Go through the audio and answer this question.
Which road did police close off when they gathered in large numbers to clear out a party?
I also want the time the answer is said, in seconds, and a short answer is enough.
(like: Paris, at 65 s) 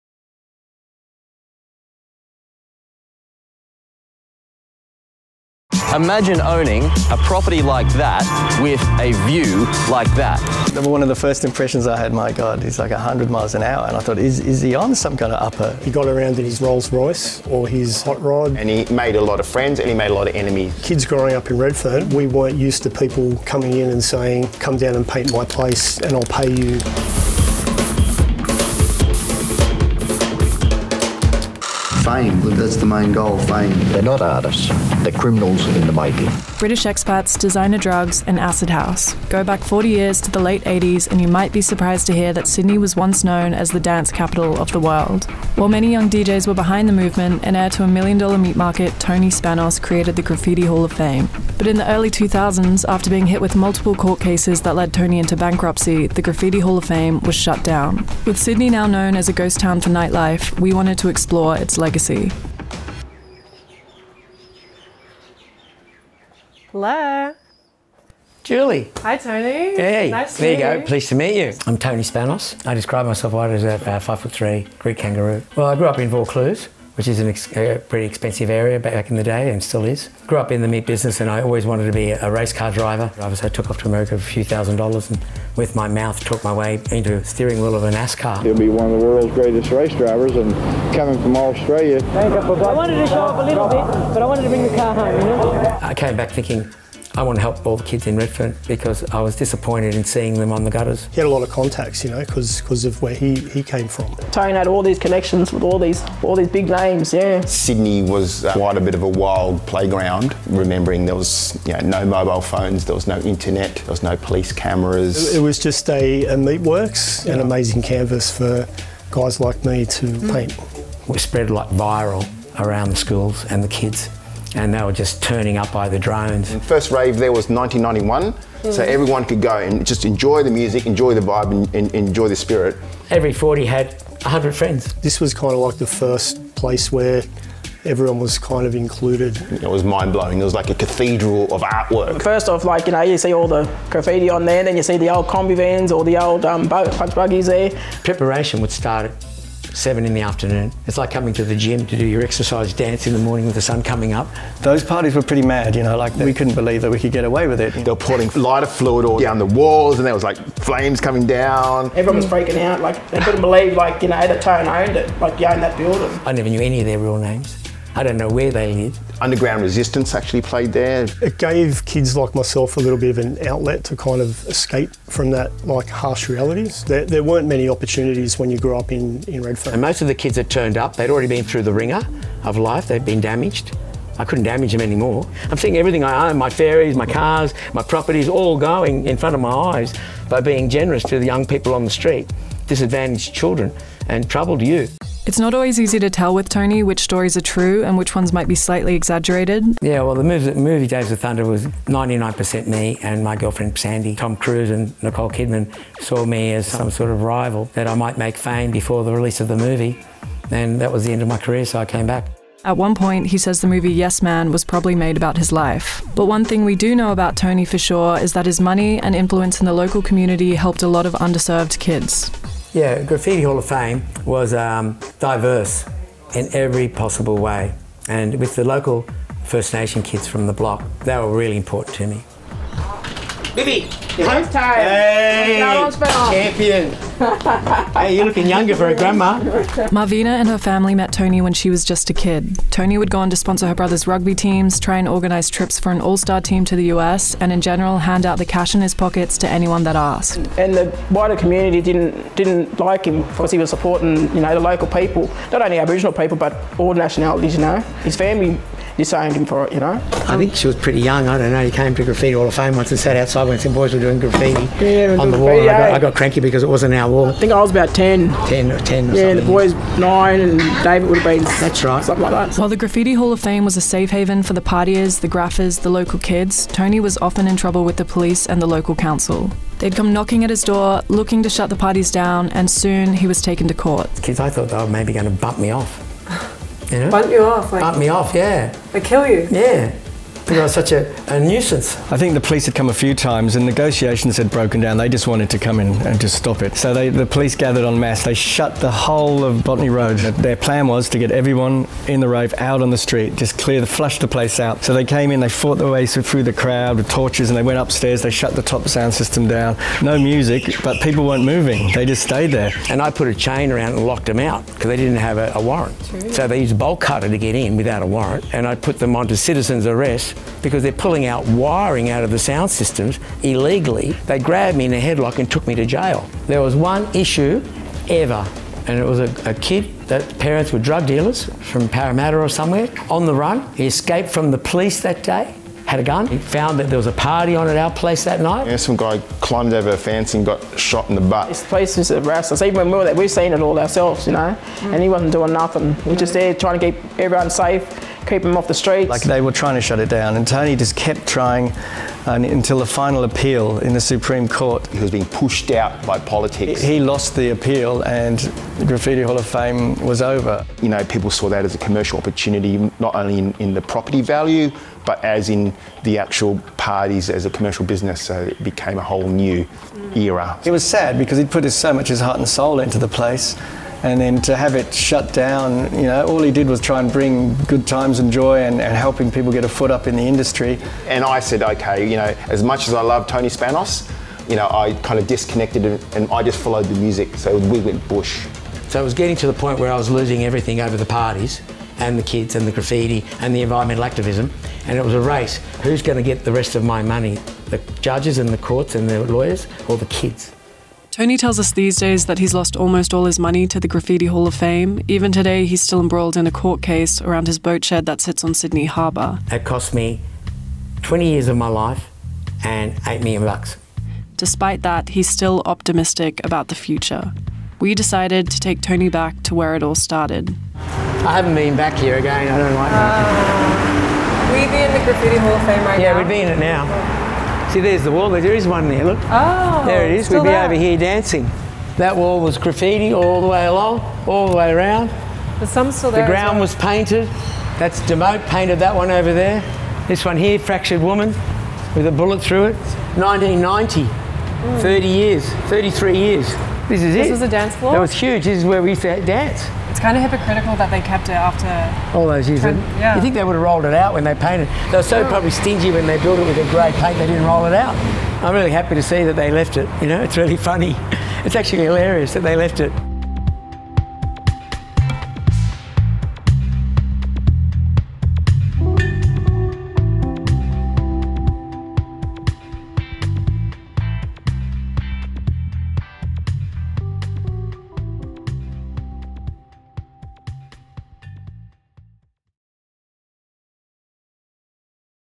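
Botany Road, at 299 s.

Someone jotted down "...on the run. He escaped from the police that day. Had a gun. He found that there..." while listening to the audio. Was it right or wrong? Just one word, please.
right.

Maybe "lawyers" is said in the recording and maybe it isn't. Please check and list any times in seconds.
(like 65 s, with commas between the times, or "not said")
399 s.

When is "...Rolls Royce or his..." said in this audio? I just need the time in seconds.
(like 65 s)
16 s.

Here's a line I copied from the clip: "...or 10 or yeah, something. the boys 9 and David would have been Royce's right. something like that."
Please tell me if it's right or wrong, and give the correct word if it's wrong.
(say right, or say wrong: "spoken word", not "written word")
wrong: "That", not "Royce".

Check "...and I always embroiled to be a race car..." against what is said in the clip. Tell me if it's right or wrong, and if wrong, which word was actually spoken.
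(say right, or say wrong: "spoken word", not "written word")
wrong: "wanted", not "embroiled".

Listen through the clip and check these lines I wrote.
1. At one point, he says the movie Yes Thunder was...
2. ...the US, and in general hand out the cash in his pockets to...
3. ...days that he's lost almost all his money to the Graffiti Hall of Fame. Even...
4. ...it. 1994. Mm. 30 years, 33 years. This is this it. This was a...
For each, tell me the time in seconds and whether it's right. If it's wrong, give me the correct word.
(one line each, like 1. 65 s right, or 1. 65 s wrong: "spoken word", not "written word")
1. 212 s wrong: "Man", not "Thunder"
2. 246 s right
3. 401 s right
4. 442 s wrong: "1990", not "1994".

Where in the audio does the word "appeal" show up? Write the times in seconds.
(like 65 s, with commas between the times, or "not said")
353 s, 357 s.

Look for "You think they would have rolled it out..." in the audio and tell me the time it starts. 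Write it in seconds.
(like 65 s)
453 s.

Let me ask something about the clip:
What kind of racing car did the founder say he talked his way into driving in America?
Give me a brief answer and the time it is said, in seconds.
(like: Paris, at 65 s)
NASCAR, at 87 s.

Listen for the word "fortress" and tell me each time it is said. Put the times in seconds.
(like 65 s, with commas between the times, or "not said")
not said.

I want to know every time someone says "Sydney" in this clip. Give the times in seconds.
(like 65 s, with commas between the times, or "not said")
42 s, 58 s, 107 s, 408 s.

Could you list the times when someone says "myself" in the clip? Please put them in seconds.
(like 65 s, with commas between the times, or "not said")
73 s, 172 s.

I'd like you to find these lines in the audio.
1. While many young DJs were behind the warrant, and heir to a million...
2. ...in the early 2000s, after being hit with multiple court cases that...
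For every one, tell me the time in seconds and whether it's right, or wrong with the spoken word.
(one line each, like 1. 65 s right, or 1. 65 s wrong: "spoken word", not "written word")
1. 45 s wrong: "movement", not "warrant"
2. 51 s right.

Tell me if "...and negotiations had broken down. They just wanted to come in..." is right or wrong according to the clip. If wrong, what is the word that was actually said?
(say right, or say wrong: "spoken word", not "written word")
right.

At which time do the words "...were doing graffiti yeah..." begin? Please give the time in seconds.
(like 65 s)
263 s.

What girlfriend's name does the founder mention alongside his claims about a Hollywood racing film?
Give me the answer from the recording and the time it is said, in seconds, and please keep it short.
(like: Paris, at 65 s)
Sandy, at 203 s.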